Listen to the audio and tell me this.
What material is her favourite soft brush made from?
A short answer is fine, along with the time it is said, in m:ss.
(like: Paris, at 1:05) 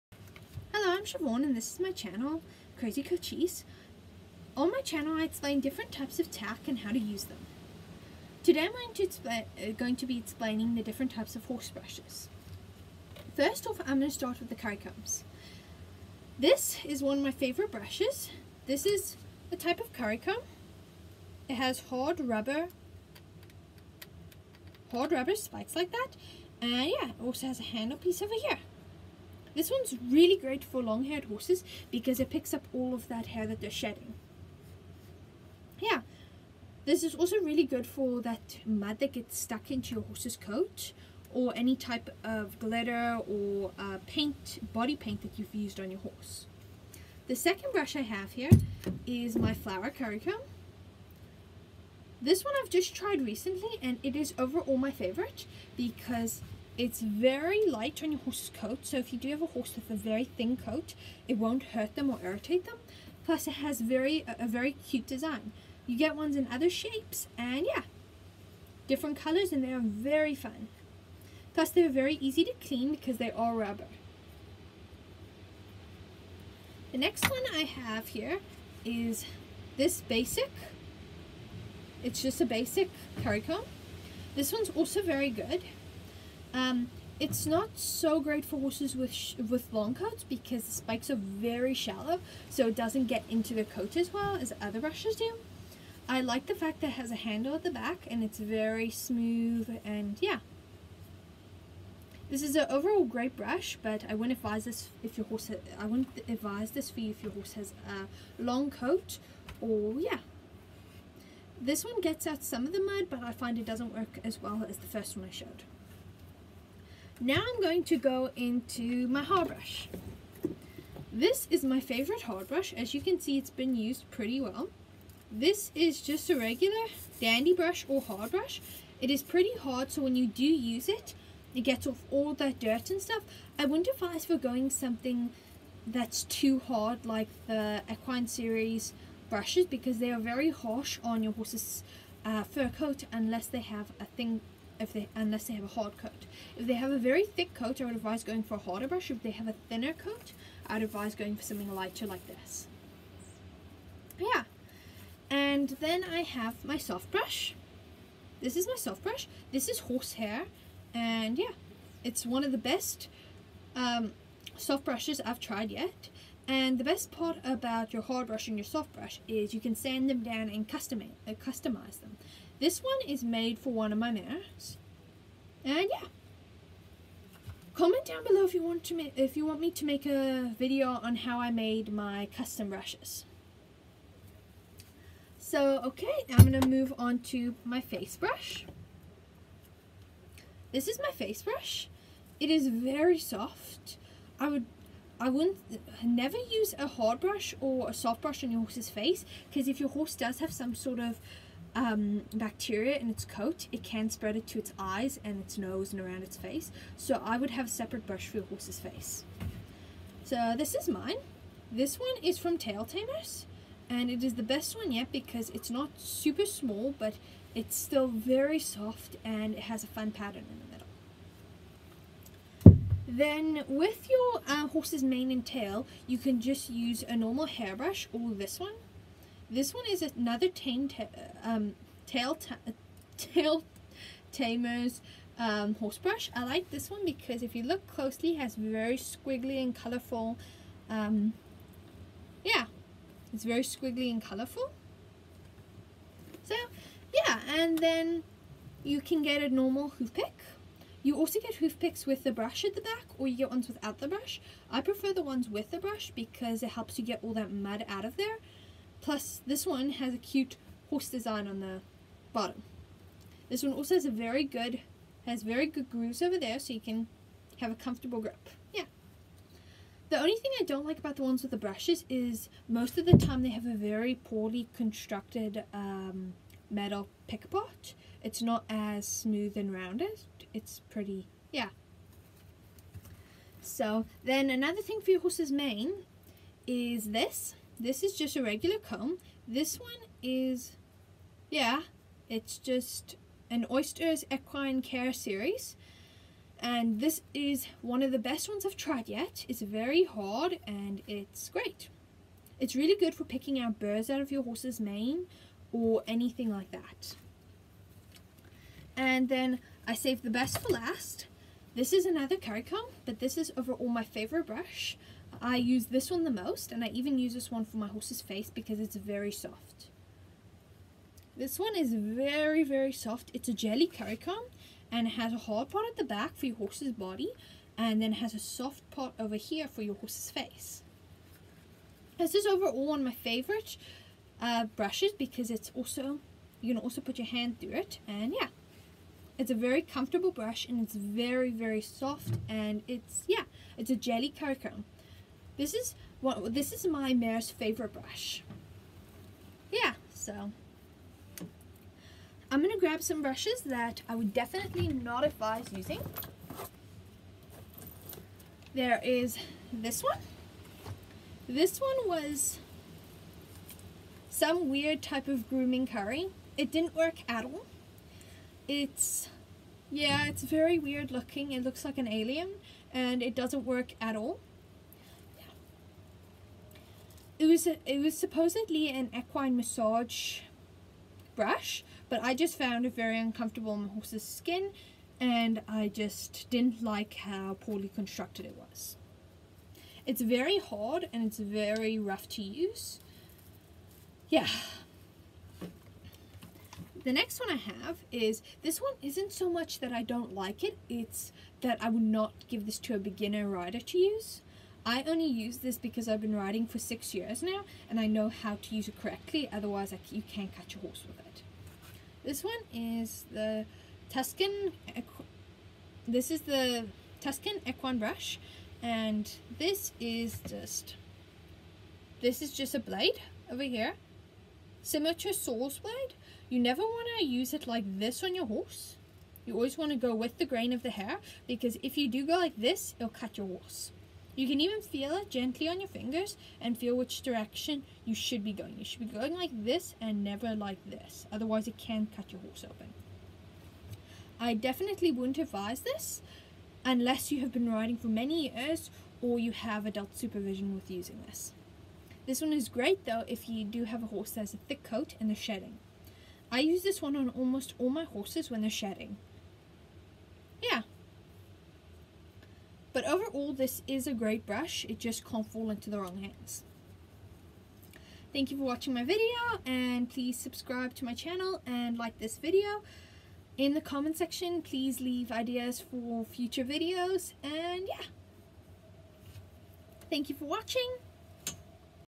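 Horsehair, at 2:39.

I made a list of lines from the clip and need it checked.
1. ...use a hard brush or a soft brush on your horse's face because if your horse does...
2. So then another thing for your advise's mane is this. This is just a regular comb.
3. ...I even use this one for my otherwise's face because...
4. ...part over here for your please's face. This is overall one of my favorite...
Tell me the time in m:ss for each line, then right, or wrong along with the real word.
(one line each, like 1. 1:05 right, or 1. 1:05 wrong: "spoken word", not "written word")
1. 3:16 right
2. 4:43 wrong: "horse", not "advise"
3. 5:16 wrong: "horse", not "otherwise"
4. 5:28 wrong: "horse", not "please".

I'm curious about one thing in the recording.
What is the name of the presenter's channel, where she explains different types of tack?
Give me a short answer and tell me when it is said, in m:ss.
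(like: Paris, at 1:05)
Crazy Cochise, at 0:02.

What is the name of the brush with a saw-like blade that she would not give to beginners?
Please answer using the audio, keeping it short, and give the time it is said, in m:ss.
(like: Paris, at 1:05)
Tuscan Equine brush, at 6:57.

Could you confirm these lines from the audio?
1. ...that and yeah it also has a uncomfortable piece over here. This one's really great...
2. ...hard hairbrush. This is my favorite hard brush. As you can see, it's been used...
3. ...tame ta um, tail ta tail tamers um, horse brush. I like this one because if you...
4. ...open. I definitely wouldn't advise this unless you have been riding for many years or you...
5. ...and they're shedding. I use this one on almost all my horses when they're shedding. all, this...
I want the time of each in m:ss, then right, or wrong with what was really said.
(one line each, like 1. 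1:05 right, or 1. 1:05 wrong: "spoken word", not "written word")
1. 0:25 wrong: "handle", not "uncomfortable"
2. 1:59 wrong: "brush", not "hairbrush"
3. 3:50 right
4. 7:22 right
5. 7:35 right.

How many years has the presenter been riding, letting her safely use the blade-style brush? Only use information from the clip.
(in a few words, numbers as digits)
6.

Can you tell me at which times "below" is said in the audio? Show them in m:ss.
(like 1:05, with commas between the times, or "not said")
2:58.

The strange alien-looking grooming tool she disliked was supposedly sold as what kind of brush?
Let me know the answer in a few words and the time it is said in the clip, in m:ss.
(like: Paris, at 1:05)
Equine massage brush, at 6:19.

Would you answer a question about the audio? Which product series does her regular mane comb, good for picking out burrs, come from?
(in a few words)
Oysters Equine Care.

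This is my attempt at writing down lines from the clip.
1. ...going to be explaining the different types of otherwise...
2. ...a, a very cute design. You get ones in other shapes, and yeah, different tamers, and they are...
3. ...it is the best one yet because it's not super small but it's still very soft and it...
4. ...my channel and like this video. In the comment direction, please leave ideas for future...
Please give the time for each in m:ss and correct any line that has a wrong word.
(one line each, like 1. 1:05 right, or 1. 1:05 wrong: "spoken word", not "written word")
1. 0:09 wrong: "horse", not "otherwise"
2. 1:04 wrong: "colors", not "tamers"
3. 3:34 right
4. 7:51 wrong: "section", not "direction".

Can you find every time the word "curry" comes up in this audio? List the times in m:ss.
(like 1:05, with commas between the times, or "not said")
0:14, 0:19, 0:49, 1:23, 5:12, 6:05.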